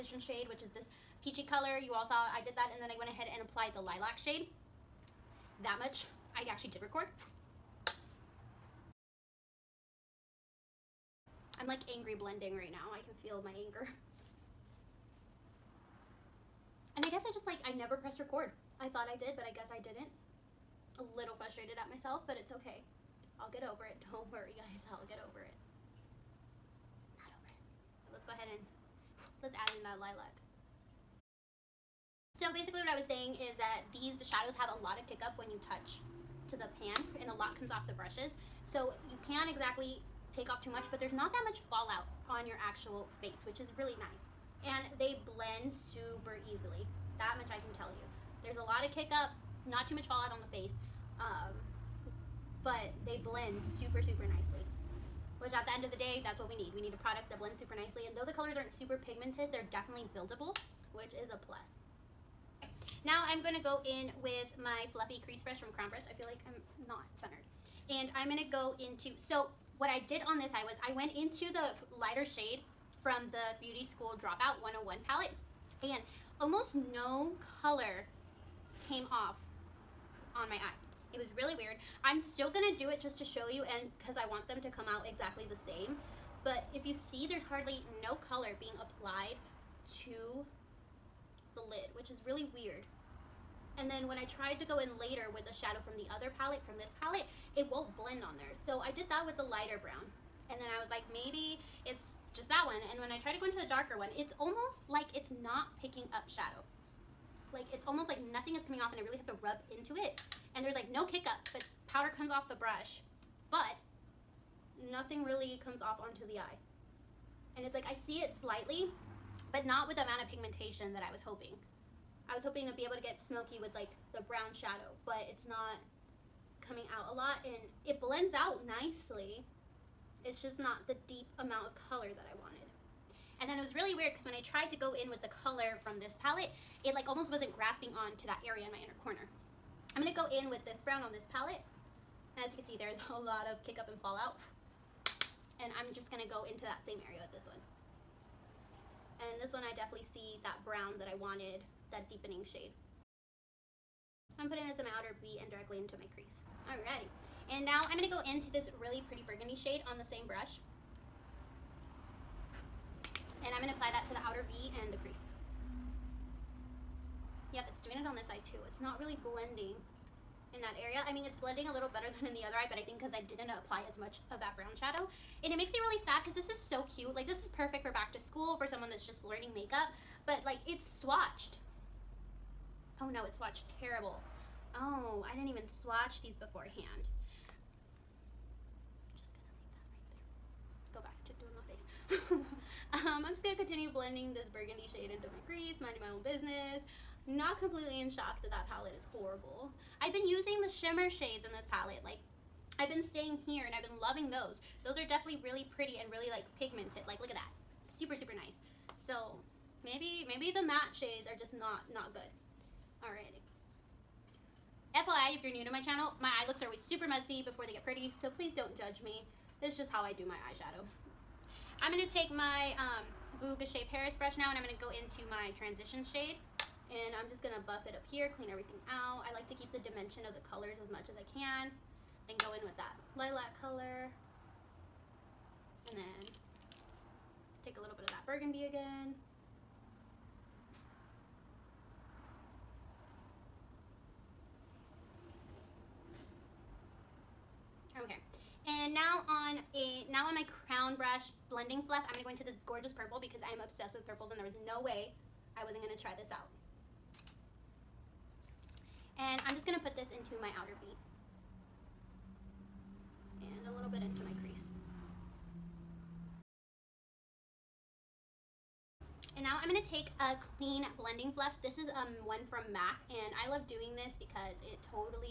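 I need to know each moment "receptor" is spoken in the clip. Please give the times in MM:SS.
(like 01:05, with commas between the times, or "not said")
not said.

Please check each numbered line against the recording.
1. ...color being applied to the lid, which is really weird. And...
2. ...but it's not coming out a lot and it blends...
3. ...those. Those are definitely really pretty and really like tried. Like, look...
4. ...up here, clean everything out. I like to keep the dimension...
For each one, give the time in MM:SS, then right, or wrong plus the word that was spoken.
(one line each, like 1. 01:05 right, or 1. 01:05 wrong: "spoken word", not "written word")
1. 01:28 right
2. 02:05 right
3. 03:24 wrong: "pigmented", not "tried"
4. 03:47 right.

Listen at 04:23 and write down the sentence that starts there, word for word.
And a little bit into my crease.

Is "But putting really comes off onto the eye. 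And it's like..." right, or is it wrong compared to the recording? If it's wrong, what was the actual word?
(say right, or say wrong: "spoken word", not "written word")
wrong: "nothing", not "putting".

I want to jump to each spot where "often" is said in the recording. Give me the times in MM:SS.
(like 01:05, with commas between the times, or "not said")
not said.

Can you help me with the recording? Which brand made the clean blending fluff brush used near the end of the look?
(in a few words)
MAC.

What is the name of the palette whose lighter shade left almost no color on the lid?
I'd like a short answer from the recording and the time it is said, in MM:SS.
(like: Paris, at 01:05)
Beauty School Dropout 101, at 01:13.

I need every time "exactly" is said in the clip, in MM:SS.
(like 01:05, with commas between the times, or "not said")
00:39, 01:25.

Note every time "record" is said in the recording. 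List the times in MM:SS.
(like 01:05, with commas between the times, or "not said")
00:06, 00:18.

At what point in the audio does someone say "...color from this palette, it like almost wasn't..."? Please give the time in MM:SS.
02:15.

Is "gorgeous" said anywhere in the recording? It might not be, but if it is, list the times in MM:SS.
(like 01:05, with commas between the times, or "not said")
04:12.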